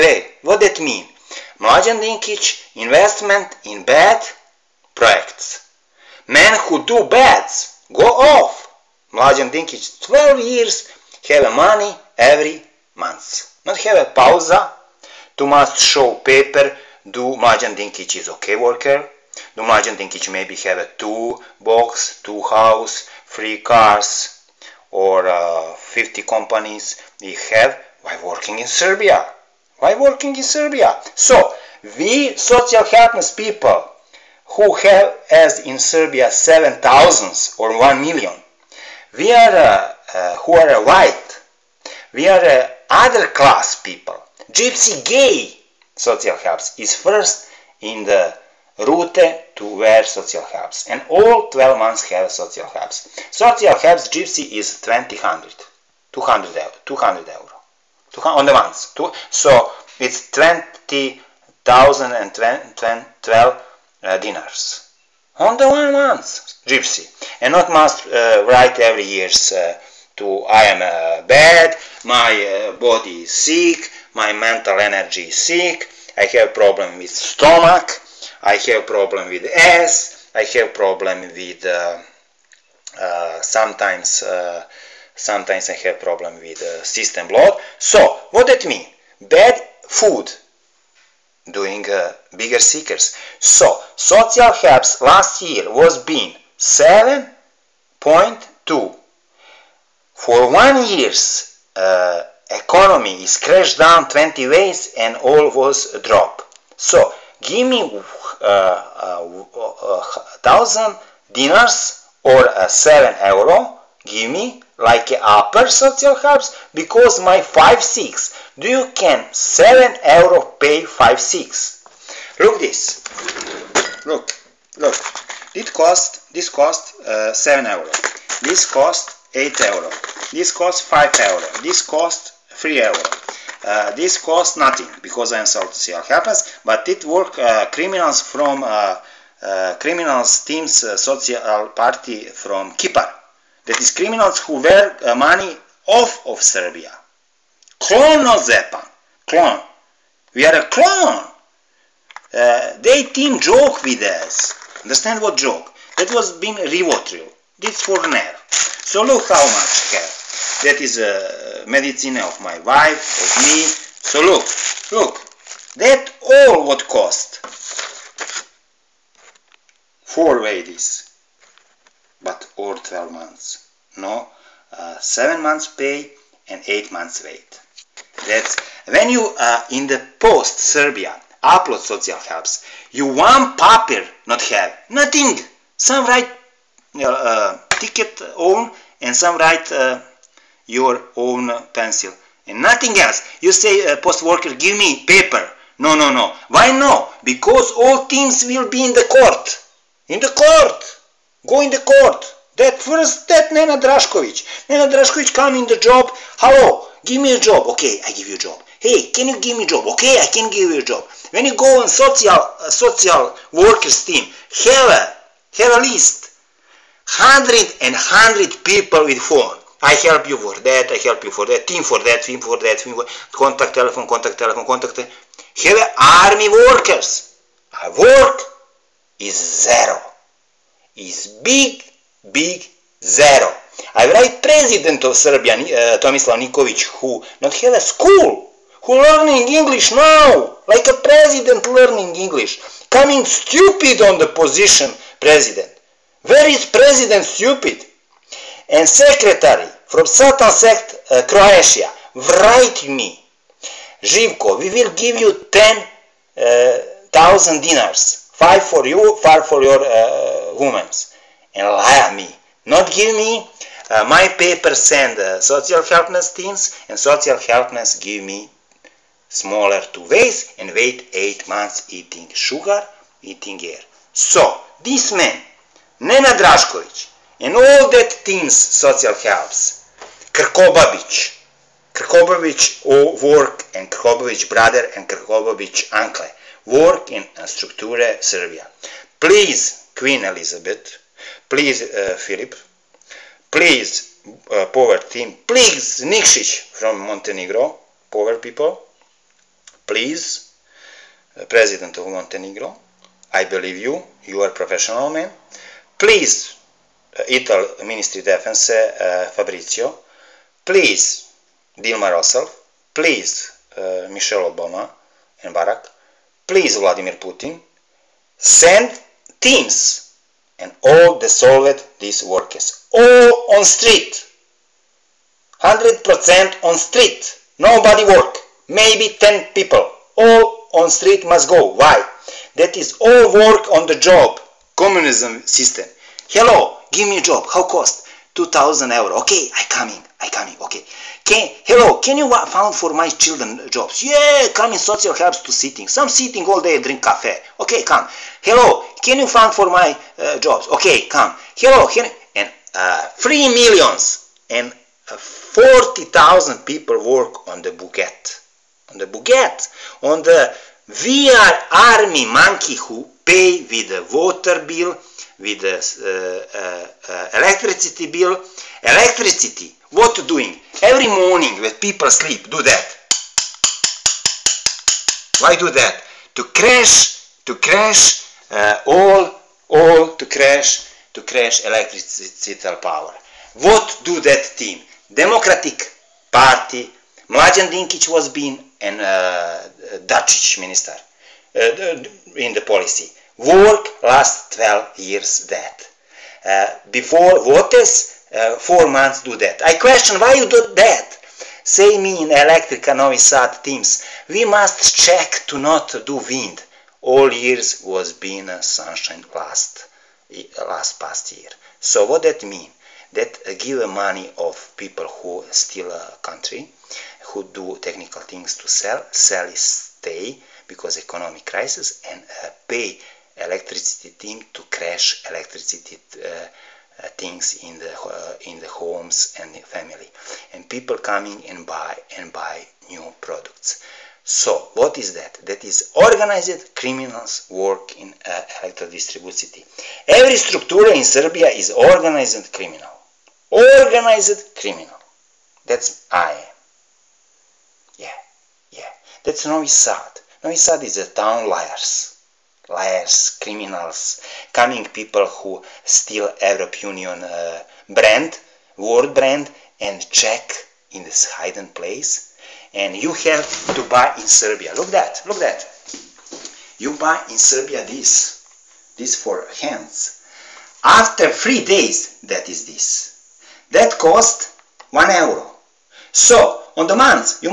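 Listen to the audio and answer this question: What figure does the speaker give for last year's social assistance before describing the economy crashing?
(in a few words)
7.2.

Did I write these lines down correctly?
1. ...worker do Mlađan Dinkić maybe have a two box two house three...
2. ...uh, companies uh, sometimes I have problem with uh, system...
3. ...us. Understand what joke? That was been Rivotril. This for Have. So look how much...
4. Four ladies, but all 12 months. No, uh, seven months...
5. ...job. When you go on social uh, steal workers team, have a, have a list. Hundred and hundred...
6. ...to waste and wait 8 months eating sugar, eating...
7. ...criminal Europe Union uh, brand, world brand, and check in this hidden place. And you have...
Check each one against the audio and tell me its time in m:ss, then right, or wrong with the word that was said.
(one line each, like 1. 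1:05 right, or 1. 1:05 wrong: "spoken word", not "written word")
1. 0:18 right
2. 1:22 wrong: "sometimes", not "companies"
3. 2:34 wrong: "Nair", not "Have"
4. 2:50 right
5. 3:30 wrong: "social", not "steal"
6. 4:29 right
7. 7:35 wrong: "steal", not "criminal".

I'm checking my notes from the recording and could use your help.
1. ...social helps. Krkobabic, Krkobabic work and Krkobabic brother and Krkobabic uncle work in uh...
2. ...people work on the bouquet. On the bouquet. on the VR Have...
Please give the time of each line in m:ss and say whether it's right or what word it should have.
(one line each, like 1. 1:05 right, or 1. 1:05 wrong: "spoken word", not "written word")
1. 4:38 right
2. 5:56 wrong: "Army", not "Have".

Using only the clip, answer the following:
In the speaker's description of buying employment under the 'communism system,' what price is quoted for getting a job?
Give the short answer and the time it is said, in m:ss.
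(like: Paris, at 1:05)
2,000 euro, at 5:38.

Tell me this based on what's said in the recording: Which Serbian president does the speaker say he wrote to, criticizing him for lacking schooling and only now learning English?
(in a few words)
Tomislav Nikolić.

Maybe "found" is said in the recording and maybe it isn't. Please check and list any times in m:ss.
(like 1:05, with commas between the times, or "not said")
5:42, 5:49.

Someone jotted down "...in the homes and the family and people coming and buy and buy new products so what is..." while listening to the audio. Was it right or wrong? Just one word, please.
right.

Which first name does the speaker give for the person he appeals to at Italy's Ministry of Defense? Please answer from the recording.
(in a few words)
Fabrizio.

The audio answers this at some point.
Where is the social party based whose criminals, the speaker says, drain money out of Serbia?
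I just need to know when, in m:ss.
2:22.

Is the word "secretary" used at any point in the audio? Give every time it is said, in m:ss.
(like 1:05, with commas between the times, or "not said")
4:08.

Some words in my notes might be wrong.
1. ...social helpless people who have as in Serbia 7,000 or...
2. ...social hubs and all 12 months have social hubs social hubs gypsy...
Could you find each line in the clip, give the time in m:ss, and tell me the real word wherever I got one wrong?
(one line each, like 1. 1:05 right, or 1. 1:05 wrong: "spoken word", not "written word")
1. 0:32 right
2. 0:50 right.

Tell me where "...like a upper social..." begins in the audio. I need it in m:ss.
1:54.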